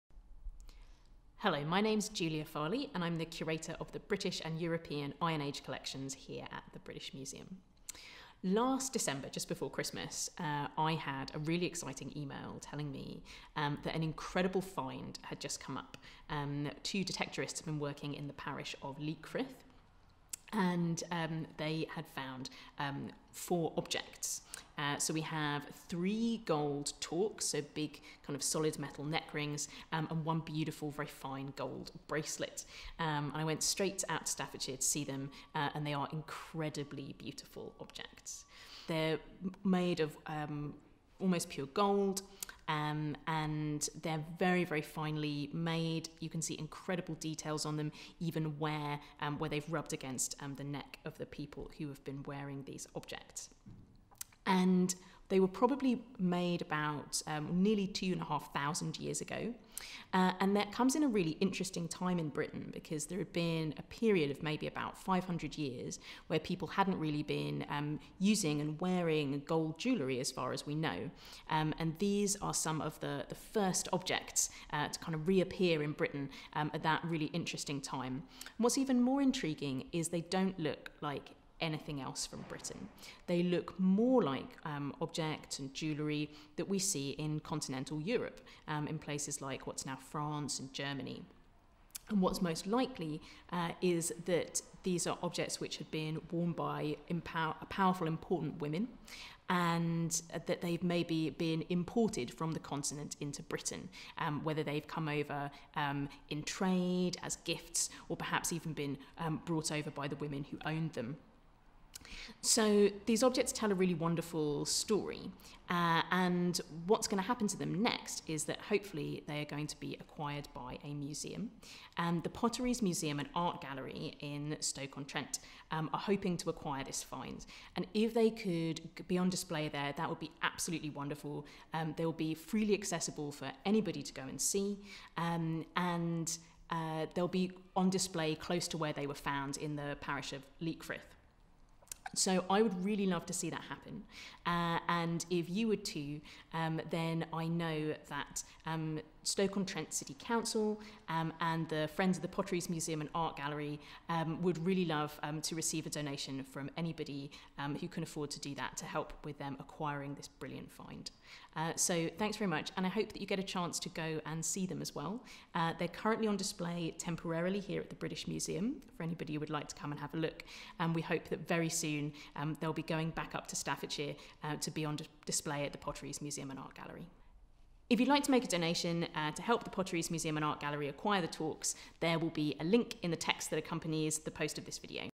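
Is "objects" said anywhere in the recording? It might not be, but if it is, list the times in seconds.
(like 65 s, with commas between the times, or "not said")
23 s, 37 s, 52 s, 73 s, 85 s, 95 s, 113 s.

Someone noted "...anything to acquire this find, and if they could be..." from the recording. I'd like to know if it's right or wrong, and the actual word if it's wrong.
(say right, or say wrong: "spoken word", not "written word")
wrong: "hoping", not "anything".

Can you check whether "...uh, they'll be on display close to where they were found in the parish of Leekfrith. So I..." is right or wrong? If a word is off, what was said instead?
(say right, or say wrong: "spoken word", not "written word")
right.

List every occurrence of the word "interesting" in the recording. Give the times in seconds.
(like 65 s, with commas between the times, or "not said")
61 s, 77 s.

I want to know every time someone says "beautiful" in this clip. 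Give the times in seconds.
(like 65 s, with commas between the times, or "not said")
30 s, 37 s.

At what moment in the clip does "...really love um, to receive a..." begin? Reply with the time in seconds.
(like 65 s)
154 s.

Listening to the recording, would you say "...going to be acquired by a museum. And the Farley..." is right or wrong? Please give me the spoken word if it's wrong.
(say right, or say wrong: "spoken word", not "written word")
wrong: "Potteries", not "Farley".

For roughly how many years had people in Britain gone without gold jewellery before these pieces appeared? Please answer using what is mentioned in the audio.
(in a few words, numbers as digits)
500.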